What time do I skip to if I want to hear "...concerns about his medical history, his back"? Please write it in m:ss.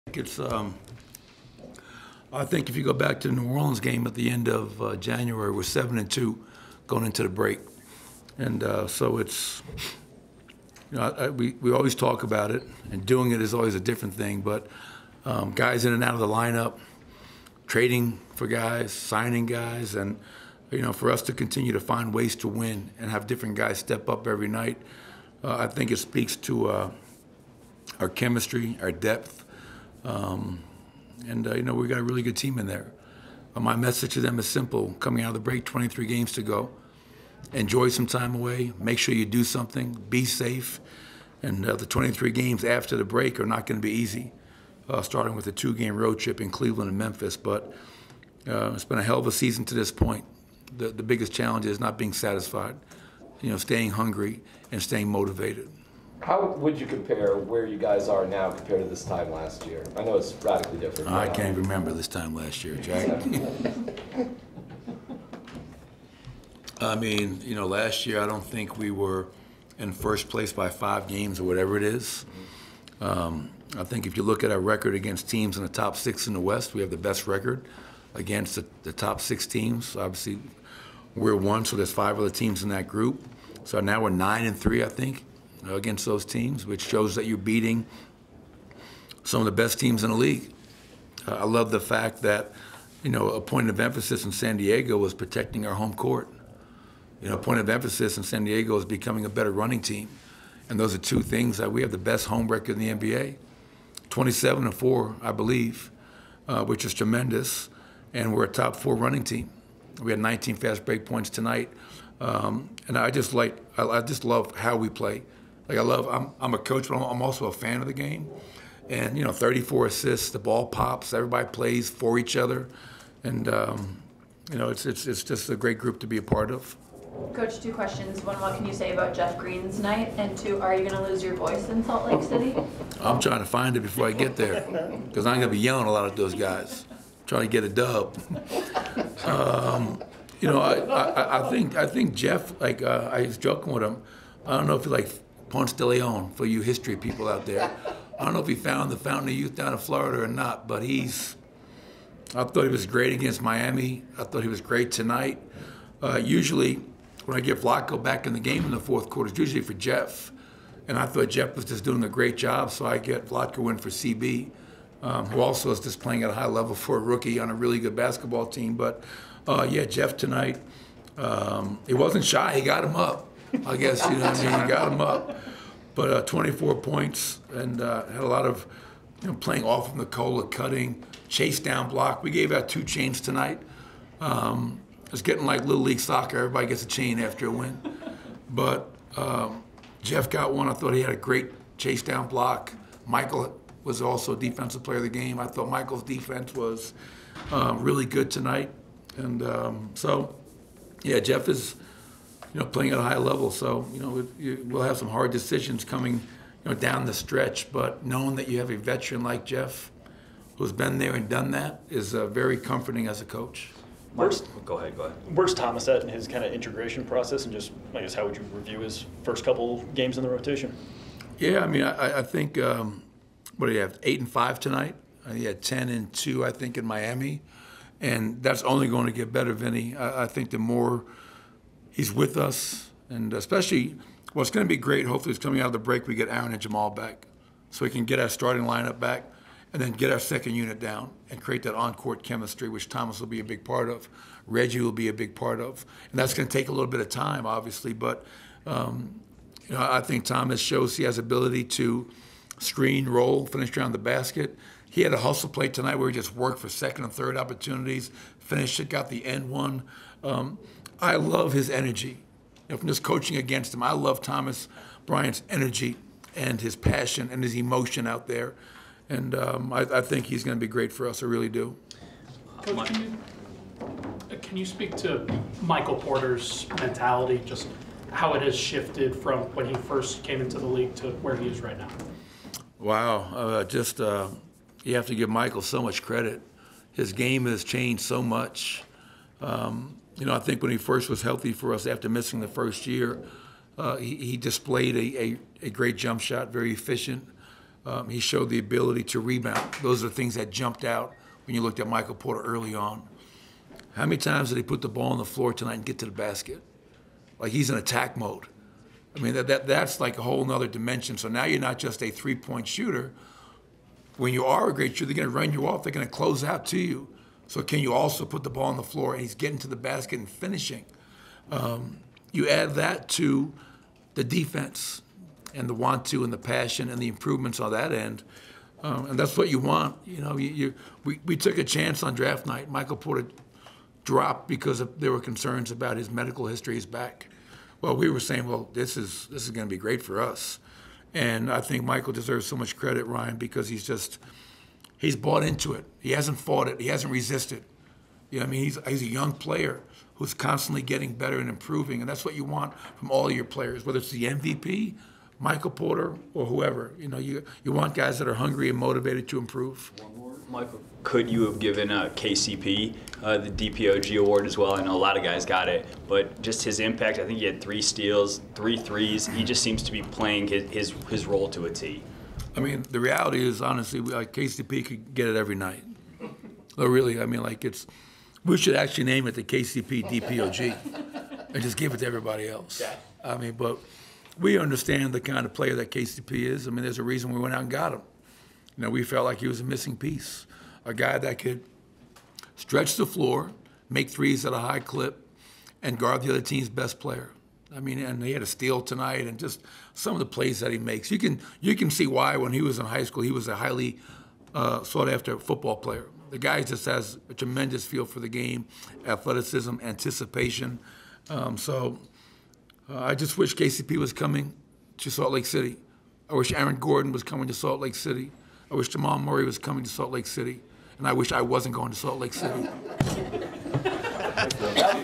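5:35.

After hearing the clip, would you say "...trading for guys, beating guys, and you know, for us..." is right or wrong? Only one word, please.
wrong.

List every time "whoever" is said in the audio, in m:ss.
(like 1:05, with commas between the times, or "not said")
5:56.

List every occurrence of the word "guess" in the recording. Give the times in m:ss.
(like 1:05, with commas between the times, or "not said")
2:53, 3:38.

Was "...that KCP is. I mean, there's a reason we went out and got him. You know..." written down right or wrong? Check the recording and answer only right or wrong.
right.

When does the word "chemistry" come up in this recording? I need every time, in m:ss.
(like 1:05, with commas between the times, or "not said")
0:28, 4:02.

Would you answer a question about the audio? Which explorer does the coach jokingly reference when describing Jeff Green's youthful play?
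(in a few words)
Ponce de Leon.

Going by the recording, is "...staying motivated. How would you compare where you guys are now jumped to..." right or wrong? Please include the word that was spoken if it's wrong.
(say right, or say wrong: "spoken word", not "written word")
wrong: "compared", not "jumped".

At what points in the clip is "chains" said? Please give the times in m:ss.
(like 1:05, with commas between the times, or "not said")
3:02, 3:06.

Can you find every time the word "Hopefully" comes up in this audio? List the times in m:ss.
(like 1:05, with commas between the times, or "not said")
3:55.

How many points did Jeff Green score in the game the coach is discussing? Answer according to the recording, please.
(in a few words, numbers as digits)
24.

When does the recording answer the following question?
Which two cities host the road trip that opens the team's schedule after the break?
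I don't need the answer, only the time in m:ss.
0:46.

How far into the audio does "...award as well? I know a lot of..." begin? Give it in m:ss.
6:04.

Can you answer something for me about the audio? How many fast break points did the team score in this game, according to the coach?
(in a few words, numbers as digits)
19.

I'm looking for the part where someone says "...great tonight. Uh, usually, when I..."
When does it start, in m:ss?
2:34.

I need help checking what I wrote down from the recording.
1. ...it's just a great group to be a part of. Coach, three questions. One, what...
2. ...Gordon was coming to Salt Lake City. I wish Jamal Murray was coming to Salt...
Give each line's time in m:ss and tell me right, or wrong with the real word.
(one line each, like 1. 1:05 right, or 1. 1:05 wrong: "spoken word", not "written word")
1. 2:05 wrong: "two", not "three"
2. 6:56 right.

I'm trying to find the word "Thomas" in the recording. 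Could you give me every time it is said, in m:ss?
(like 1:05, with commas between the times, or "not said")
3:35, 4:02, 4:10, 4:24.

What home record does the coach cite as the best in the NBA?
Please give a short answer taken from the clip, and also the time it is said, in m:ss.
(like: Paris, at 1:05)
27 and 4, at 1:44.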